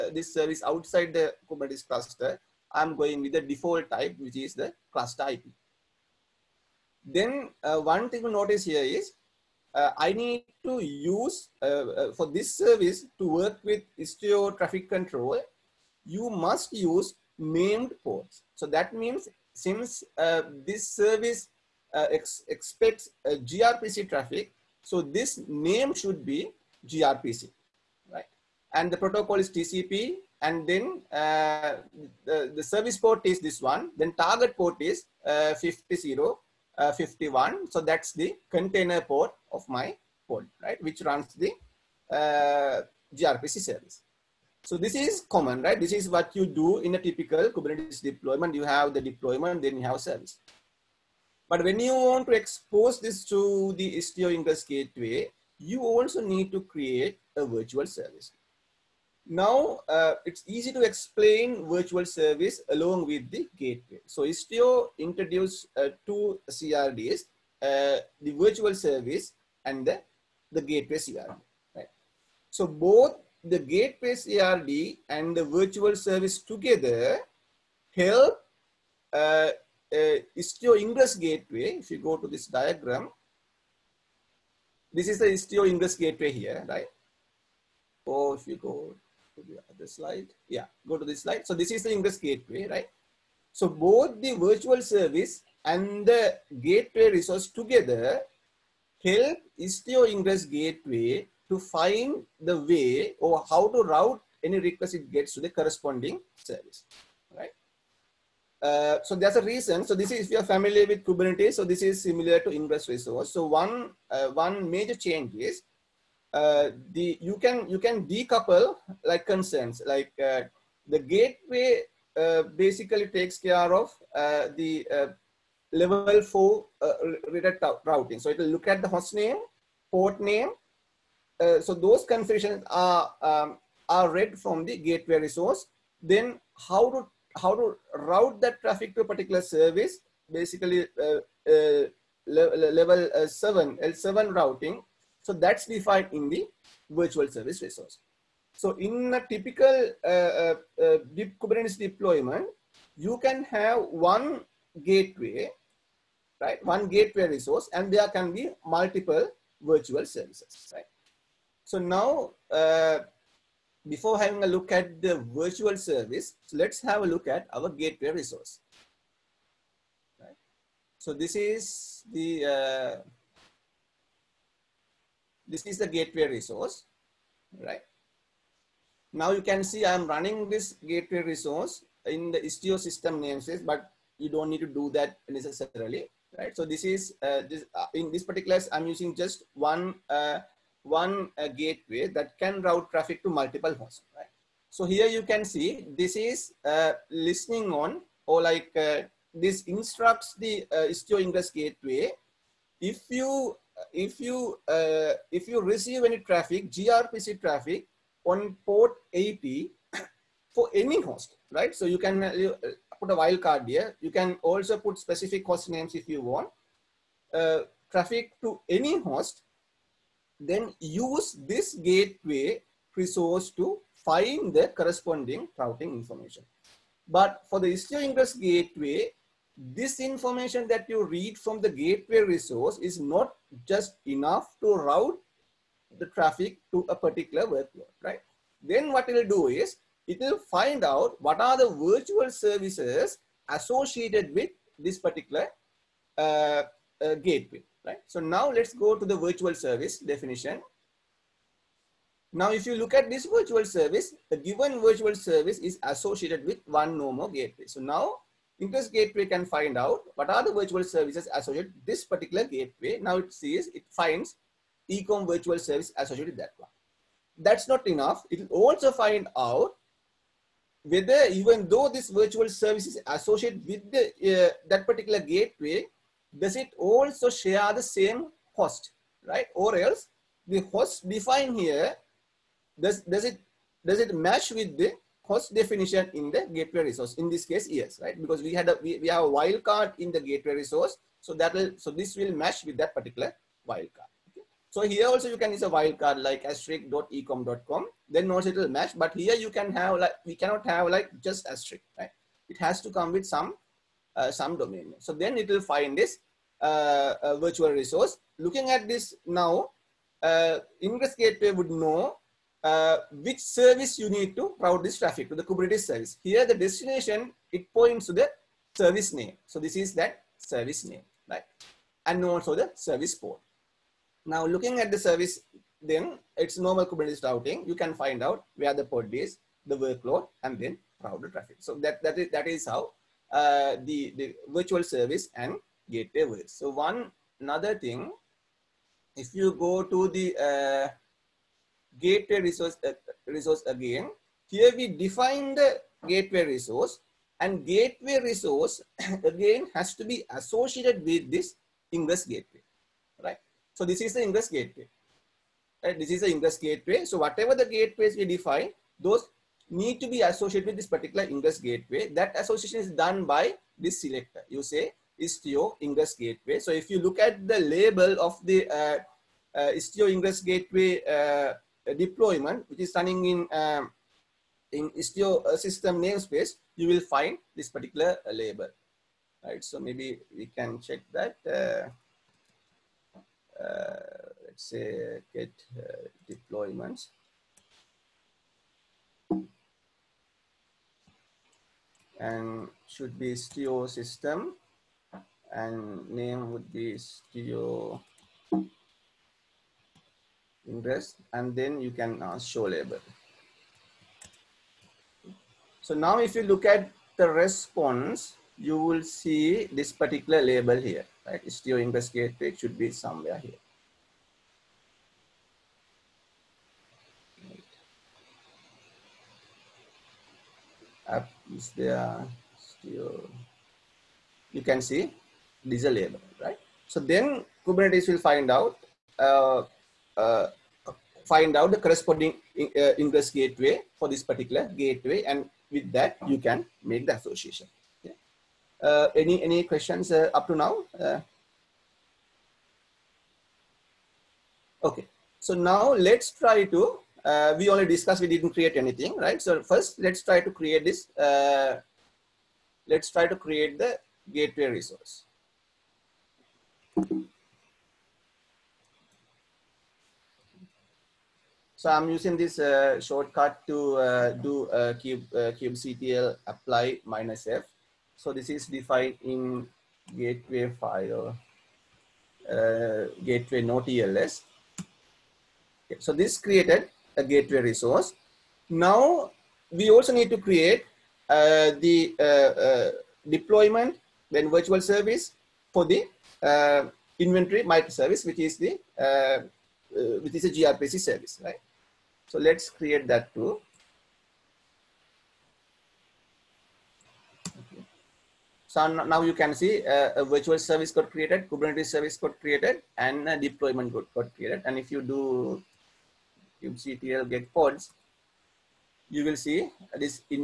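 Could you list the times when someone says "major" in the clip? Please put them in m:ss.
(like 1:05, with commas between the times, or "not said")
1:54.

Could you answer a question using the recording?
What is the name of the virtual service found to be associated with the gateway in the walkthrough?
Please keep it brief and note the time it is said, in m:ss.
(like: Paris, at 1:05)
ecom, at 4:24.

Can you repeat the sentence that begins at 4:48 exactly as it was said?
Because we had a, we, we have a wildcard in the gateway resource.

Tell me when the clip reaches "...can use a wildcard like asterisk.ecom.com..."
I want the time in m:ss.
4:55.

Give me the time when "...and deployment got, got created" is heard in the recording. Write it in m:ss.
8:22.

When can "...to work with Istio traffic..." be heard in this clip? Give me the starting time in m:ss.
0:13.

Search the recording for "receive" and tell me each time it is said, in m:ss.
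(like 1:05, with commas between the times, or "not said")
3:25.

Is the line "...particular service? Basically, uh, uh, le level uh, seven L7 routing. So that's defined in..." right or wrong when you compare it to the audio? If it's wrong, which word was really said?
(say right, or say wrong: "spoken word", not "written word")
right.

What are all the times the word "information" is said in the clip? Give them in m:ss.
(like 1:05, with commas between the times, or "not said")
3:45, 3:49.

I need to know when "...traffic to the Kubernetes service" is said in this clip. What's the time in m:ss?
5:14.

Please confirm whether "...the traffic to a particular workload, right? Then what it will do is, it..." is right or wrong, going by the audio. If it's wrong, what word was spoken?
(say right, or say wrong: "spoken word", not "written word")
right.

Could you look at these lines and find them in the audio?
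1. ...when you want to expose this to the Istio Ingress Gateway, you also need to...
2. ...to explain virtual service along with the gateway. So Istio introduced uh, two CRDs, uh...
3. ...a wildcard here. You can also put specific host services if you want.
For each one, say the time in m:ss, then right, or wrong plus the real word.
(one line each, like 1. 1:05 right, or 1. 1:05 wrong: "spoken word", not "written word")
1. 0:51 right
2. 1:00 right
3. 3:33 wrong: "names", not "services".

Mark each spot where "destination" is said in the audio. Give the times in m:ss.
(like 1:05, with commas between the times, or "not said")
5:16.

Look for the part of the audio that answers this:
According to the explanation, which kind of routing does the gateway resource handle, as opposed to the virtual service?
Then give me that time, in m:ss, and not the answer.
2:05.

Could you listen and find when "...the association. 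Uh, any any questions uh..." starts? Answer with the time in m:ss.
7:17.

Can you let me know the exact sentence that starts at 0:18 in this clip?
So that means since uh, this service uh, ex expects uh, gRPC traffic, so this name should be gRPC, right?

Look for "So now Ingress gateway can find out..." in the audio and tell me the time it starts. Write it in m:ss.
4:17.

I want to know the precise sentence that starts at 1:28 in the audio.
Or if you go to the other slide, yeah, go to this slide.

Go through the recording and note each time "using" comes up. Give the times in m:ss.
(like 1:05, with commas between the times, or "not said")
3:08, 7:42.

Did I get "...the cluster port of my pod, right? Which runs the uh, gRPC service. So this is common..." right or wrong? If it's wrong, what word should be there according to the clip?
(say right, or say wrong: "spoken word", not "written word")
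wrong: "container", not "cluster".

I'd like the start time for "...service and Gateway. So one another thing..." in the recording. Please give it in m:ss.
5:34.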